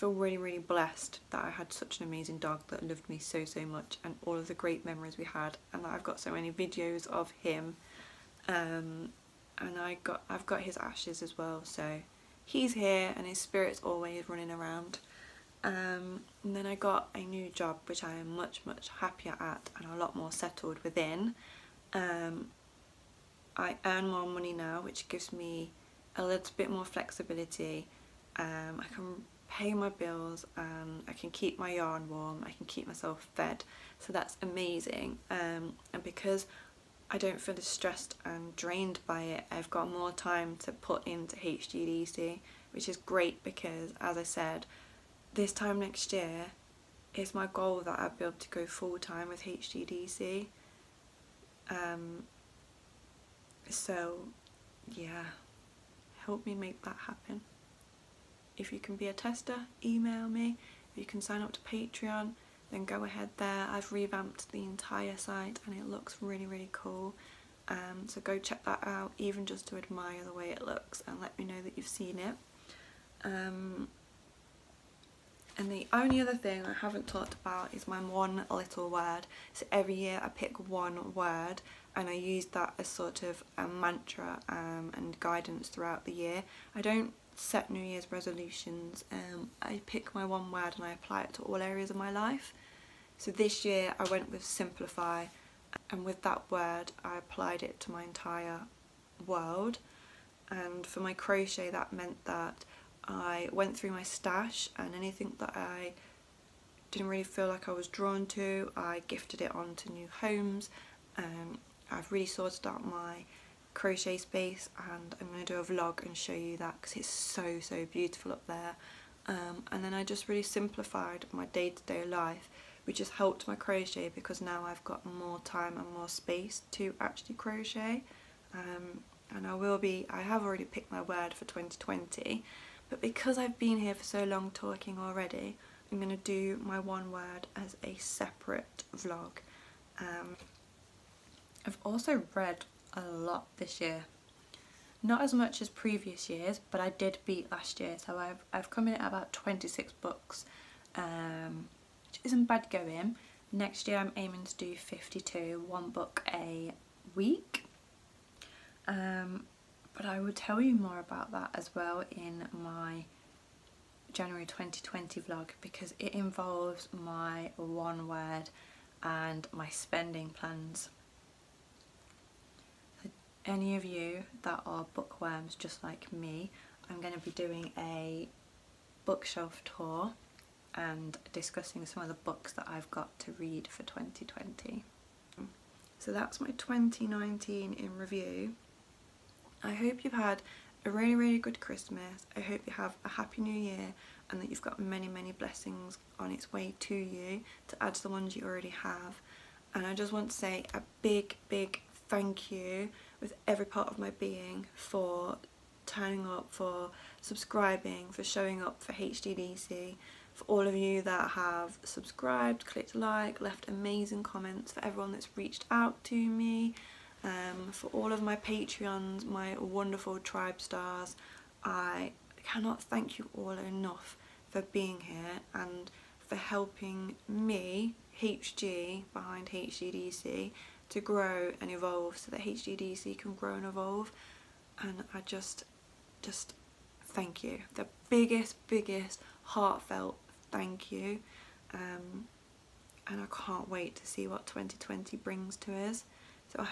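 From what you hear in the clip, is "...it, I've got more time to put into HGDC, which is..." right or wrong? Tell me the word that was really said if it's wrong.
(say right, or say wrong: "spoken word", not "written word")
right.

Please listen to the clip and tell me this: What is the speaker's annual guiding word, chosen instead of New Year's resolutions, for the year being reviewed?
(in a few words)
simplify.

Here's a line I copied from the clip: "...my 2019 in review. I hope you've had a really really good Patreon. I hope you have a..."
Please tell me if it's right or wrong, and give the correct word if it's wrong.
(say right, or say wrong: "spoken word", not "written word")
wrong: "Christmas", not "Patreon".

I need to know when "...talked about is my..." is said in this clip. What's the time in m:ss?
1:17.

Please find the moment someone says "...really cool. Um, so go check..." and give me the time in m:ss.
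1:06.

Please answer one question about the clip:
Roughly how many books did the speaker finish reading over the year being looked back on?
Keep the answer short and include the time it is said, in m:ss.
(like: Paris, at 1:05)
26, at 2:29.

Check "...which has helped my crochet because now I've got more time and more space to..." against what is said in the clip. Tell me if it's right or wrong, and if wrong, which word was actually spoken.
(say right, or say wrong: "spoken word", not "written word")
right.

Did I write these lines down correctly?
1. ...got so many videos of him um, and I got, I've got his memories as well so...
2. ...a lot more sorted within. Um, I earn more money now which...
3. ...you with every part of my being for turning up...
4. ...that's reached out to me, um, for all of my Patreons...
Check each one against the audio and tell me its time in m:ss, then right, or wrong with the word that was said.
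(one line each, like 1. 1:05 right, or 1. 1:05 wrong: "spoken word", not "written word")
1. 0:06 wrong: "ashes", not "memories"
2. 0:19 wrong: "settled", not "sorted"
3. 3:22 right
4. 3:35 right.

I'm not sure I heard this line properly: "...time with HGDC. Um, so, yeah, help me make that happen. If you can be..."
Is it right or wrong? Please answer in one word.
right.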